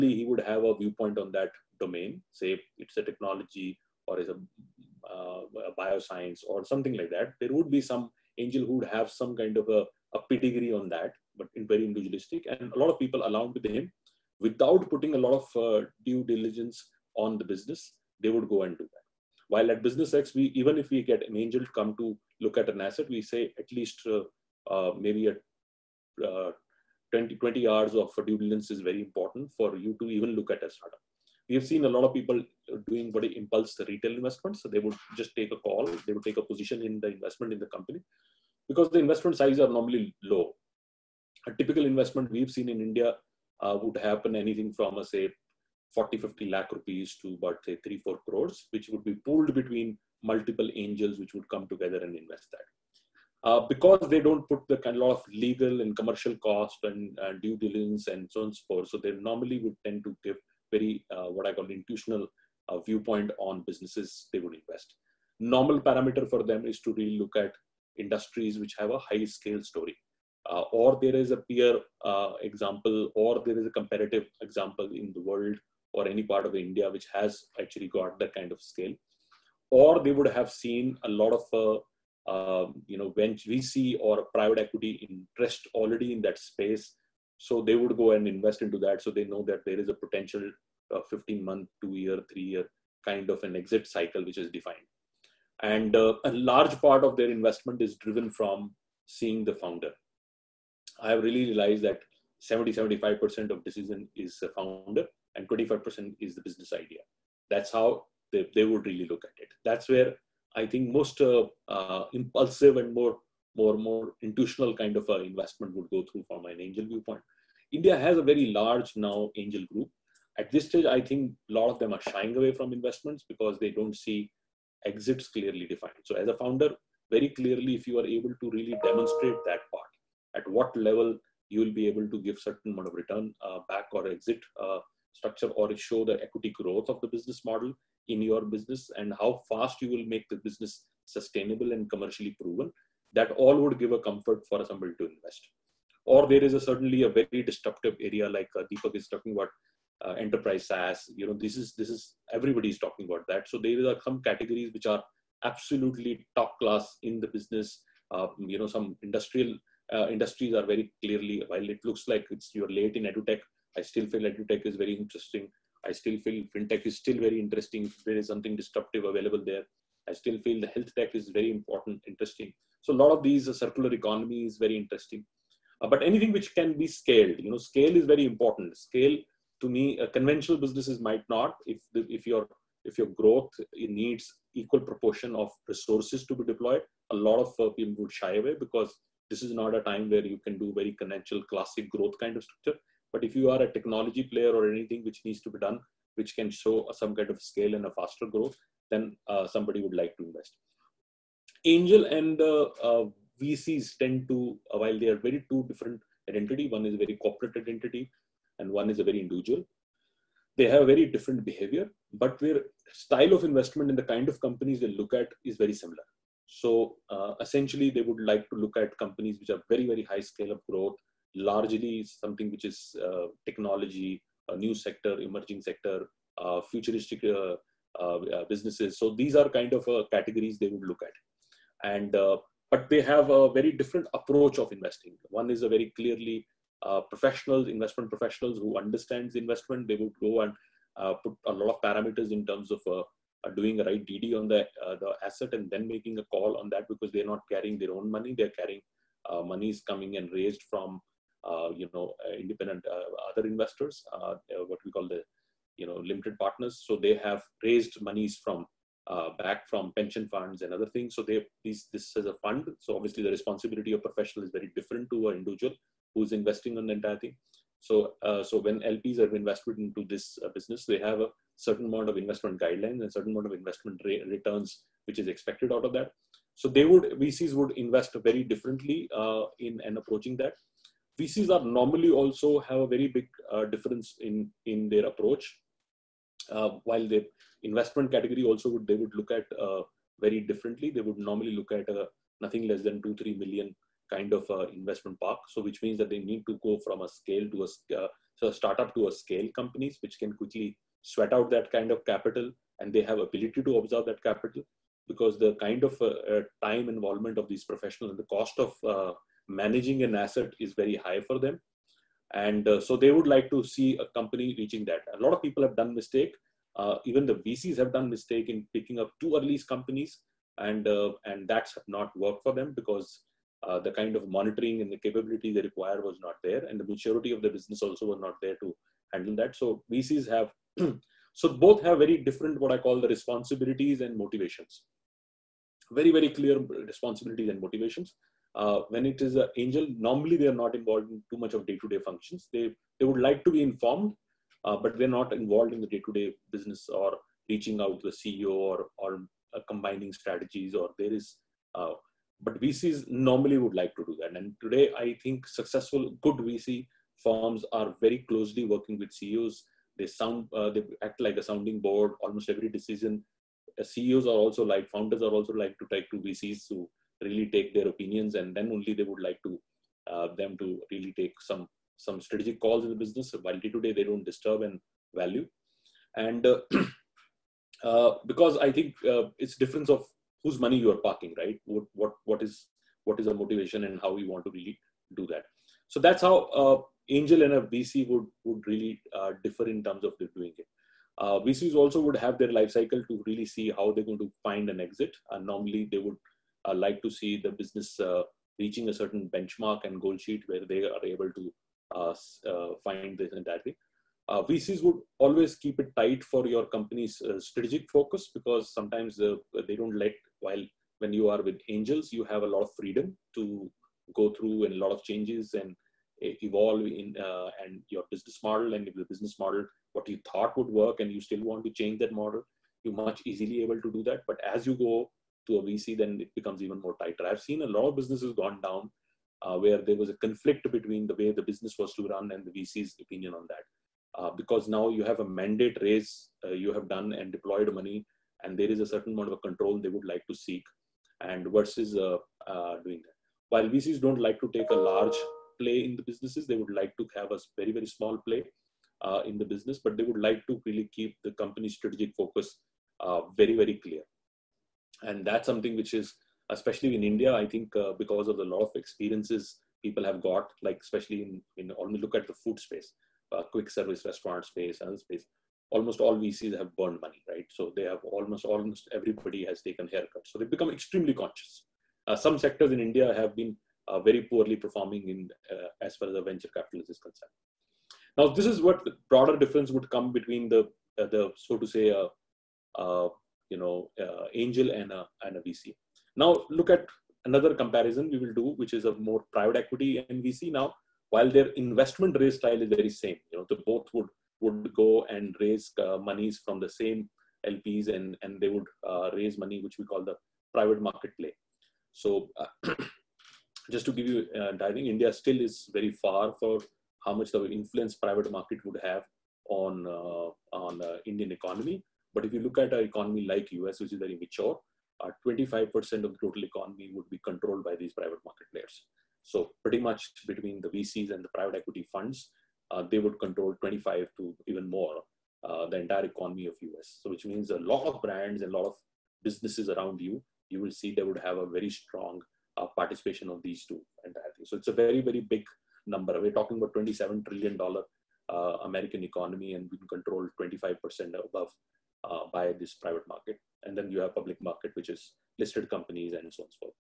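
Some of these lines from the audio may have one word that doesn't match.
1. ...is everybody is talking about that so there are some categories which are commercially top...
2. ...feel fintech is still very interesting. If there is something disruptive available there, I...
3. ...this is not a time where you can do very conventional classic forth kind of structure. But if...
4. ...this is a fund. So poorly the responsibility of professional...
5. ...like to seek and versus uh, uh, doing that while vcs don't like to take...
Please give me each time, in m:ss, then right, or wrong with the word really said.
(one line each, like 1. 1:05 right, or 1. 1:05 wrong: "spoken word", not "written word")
1. 2:31 wrong: "absolutely", not "commercially"
2. 2:46 right
3. 3:09 wrong: "growth", not "forth"
4. 4:21 wrong: "obviously", not "poorly"
5. 7:20 right.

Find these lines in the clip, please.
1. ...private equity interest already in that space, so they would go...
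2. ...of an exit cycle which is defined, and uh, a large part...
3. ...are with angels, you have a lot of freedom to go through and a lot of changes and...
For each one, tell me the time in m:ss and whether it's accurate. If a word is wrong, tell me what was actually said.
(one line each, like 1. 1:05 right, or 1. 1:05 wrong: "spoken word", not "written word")
1. 1:24 right
2. 1:33 right
3. 6:51 right.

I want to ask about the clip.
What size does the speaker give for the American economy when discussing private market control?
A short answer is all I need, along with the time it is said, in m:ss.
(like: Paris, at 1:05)
$27 trillion, at 8:56.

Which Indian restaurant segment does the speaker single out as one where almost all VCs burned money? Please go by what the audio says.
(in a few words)
Quick service restaurant.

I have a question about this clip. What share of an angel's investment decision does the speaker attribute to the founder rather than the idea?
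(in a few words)
70-75%.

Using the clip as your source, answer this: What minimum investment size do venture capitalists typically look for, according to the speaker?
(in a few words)
2-3 million.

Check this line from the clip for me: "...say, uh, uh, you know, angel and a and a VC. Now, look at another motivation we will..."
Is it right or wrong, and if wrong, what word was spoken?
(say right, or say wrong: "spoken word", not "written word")
wrong: "comparison", not "motivation".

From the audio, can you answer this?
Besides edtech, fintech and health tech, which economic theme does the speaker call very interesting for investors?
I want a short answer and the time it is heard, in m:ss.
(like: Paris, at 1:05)
Circular economy, at 2:53.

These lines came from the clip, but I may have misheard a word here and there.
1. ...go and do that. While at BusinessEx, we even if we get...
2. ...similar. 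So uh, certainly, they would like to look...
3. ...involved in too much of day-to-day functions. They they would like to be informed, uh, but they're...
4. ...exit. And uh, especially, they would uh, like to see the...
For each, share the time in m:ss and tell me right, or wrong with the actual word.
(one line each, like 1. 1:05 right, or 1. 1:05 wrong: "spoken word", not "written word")
1. 0:18 right
2. 3:35 wrong: "essentially", not "certainly"
3. 5:40 right
4. 6:34 wrong: "normally", not "especially".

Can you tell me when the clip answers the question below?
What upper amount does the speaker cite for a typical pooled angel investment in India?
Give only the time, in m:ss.
0:47.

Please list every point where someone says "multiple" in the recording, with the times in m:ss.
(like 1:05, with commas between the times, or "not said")
0:50.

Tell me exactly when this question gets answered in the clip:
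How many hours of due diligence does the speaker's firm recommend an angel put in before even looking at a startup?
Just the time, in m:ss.
0:27.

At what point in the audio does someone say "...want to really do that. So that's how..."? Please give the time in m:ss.
6:24.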